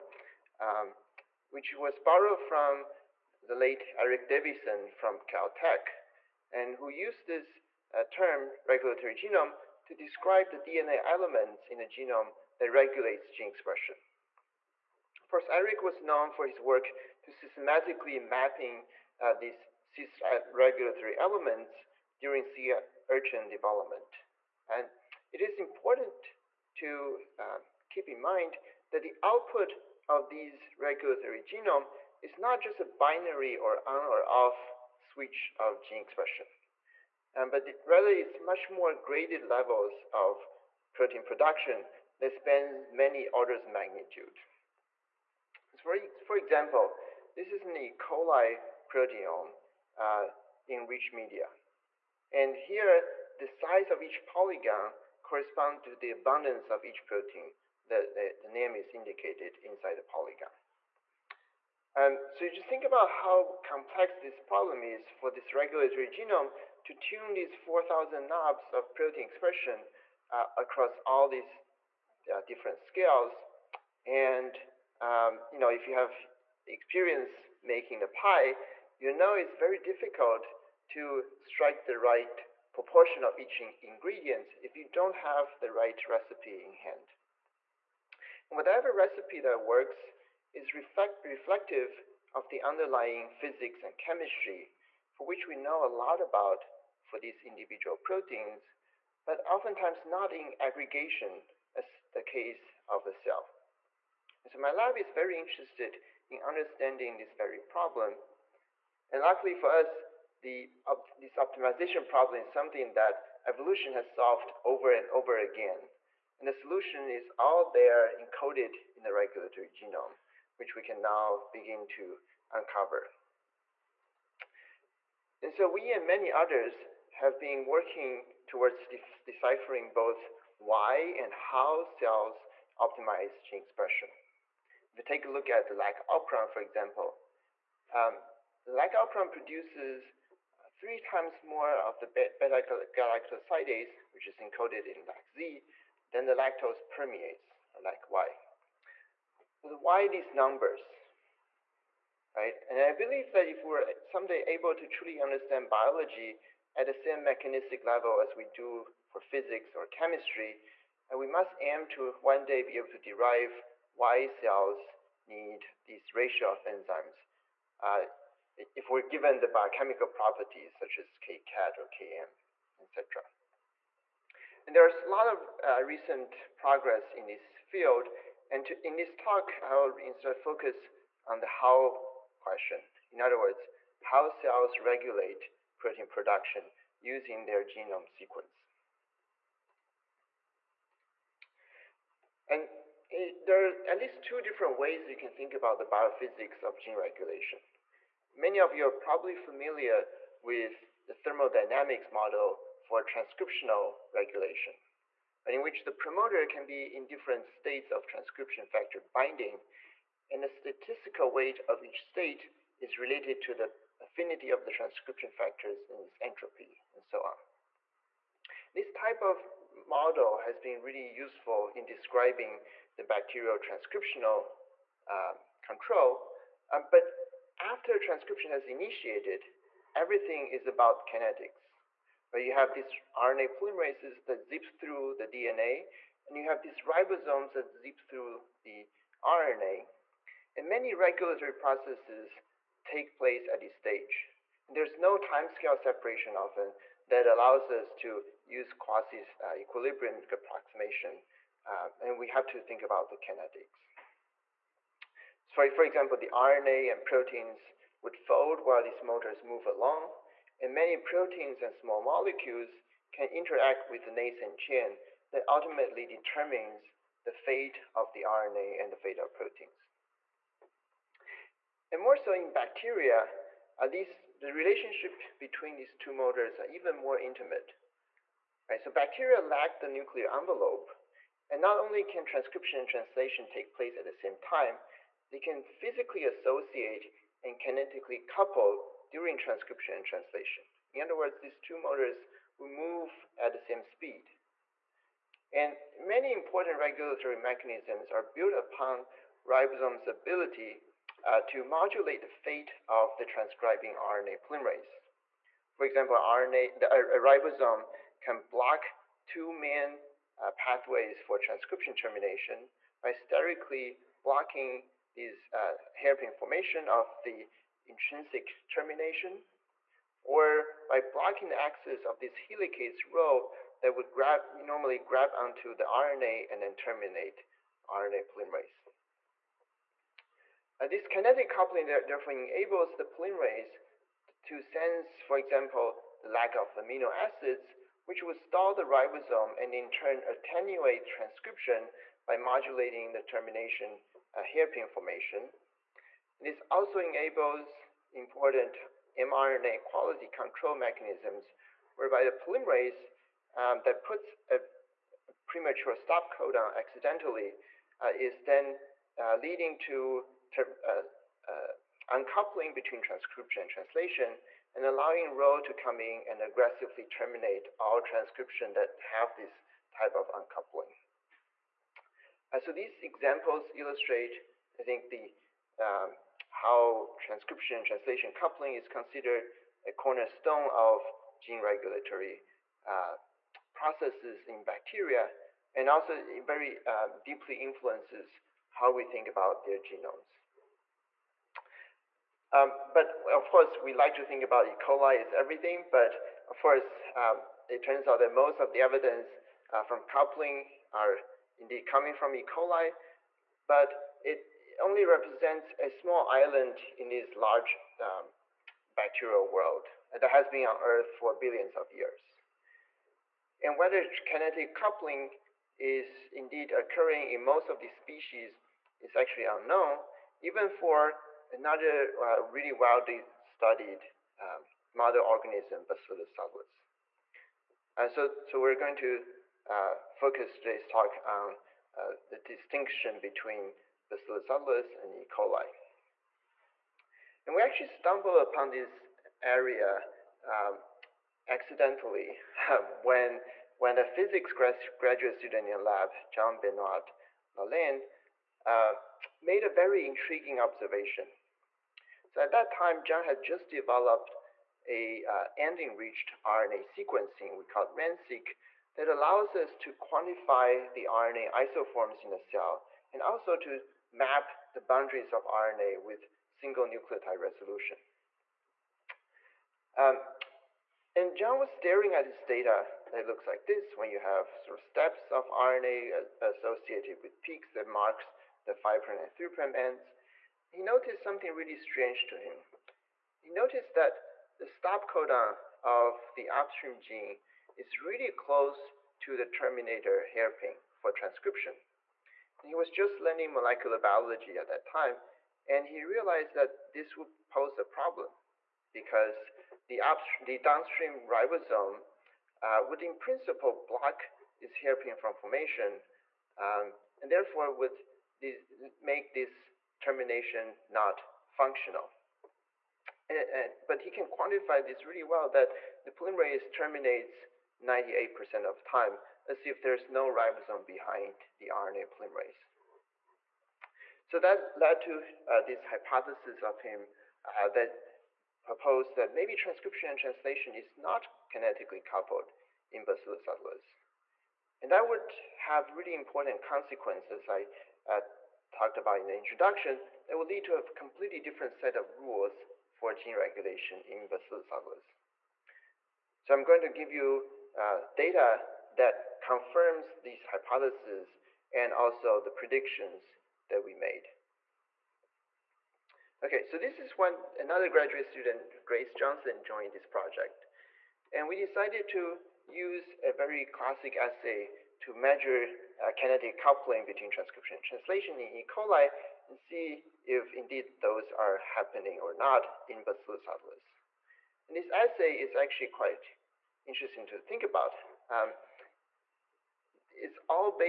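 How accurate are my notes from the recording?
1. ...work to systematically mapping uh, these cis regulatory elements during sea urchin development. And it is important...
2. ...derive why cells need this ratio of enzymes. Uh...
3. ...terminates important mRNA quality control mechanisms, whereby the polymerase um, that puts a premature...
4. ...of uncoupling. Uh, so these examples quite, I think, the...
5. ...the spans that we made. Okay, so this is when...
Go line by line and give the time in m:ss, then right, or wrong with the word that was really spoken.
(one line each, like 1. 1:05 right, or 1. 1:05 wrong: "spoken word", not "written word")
1. 0:16 right
2. 2:42 right
3. 5:46 wrong: "enables", not "terminates"
4. 6:10 wrong: "illustrate", not "quite"
5. 9:12 wrong: "predictions", not "spans".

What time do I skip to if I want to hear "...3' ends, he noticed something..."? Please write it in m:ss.
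7:59.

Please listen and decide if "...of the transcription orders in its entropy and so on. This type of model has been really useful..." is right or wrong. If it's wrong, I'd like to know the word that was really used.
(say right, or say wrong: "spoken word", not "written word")
wrong: "factors", not "orders".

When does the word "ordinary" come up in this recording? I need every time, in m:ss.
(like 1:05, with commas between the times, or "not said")
not said.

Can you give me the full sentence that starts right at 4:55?
And many important regulatory mechanisms are built upon ribosome's ability uh, to modulate the fate of the transcribing RNA polymerase.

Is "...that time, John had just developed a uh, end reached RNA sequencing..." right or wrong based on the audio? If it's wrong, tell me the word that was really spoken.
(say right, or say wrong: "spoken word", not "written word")
right.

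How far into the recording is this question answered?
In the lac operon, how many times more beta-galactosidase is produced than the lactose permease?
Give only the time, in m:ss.
2:20.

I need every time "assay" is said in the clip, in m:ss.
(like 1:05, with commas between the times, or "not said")
9:24, 9:34.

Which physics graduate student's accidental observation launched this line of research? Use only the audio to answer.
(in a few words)
John Benoit Lalanne.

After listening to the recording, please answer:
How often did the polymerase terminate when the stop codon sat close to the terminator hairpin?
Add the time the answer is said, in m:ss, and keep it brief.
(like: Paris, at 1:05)
98%, at 8:37.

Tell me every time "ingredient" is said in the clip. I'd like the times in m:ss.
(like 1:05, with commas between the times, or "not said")
1:23.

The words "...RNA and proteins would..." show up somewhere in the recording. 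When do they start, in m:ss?
4:16.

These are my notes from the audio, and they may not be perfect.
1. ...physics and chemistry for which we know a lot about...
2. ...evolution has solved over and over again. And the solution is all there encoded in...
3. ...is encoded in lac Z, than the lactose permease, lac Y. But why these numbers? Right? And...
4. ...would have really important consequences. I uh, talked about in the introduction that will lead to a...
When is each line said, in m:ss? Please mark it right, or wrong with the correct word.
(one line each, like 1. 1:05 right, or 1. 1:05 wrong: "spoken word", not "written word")
1. 1:33 right
2. 1:53 right
3. 2:24 right
4. 8:55 right.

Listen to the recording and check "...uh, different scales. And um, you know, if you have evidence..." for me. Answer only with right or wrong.
wrong.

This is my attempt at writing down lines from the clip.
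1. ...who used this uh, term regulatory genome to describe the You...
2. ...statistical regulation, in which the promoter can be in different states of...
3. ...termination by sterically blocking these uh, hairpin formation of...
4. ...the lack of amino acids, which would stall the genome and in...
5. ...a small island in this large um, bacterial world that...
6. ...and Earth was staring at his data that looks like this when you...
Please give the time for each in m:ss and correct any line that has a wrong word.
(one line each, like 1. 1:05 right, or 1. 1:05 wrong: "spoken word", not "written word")
1. 0:06 wrong: "DNA", not "You"
2. 3:23 wrong: "transcriptional", not "statistical"
3. 5:11 right
4. 5:36 wrong: "ribosome", not "genome"
5. 6:45 right
6. 7:51 wrong: "John", not "Earth".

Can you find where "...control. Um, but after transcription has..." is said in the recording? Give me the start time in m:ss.
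3:45.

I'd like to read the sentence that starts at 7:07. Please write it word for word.
And uh, so, so we're going to uh, focus today's talk on uh, the distinction between Bacillus subtilis and E.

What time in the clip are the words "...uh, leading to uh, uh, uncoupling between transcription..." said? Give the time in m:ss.
5:59.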